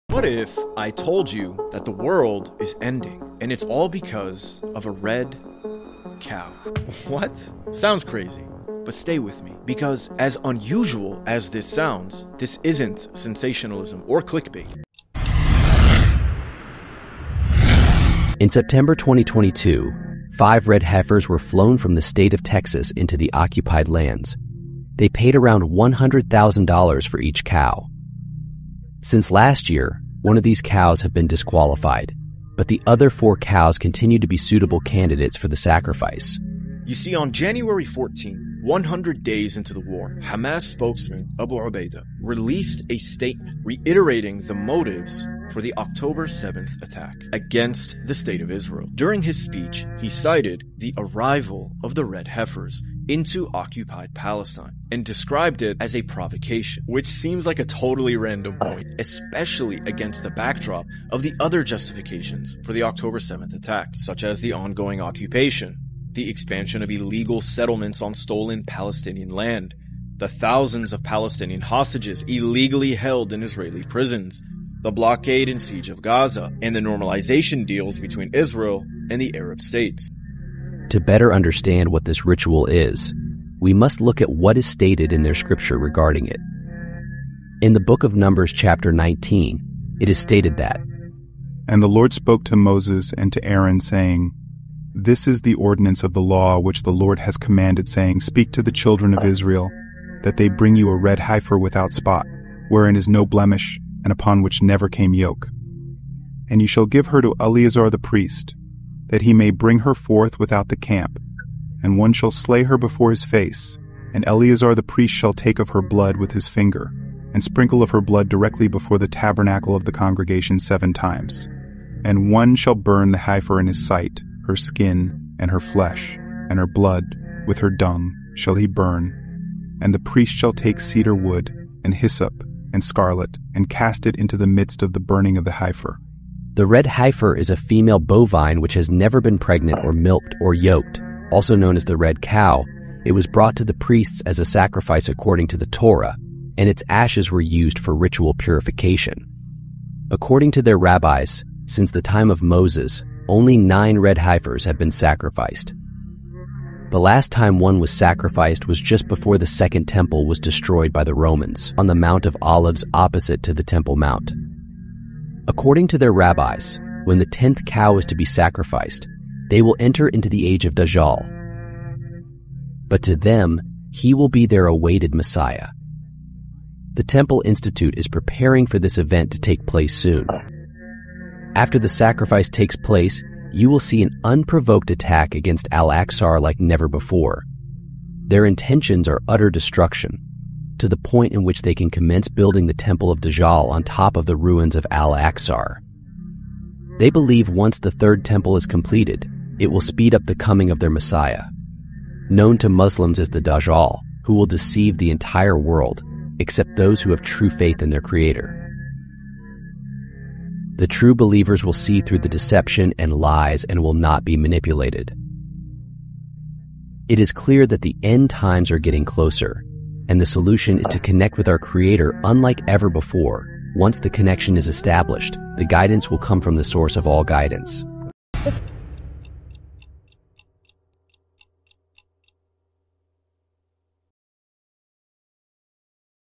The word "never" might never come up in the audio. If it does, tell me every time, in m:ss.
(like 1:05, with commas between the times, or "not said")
1:44, 2:18, 3:06.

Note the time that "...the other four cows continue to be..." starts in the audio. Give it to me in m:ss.
0:32.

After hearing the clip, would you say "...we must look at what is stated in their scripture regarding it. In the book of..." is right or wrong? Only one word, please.
right.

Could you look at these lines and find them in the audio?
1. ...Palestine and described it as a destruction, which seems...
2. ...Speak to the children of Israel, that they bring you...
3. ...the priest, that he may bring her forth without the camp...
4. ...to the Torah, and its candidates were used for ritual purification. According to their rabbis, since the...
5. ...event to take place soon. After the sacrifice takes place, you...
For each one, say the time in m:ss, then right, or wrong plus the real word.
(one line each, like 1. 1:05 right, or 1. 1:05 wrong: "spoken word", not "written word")
1. 0:54 wrong: "provocation", not "destruction"
2. 1:38 right
3. 1:47 right
4. 2:25 wrong: "ashes", not "candidates"
5. 2:58 right.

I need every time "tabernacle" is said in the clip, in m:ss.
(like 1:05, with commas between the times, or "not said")
1:59.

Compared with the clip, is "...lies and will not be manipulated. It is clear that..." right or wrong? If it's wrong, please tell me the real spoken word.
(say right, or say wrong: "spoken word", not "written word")
right.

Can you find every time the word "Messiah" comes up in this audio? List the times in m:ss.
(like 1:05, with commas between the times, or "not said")
2:55, 3:20.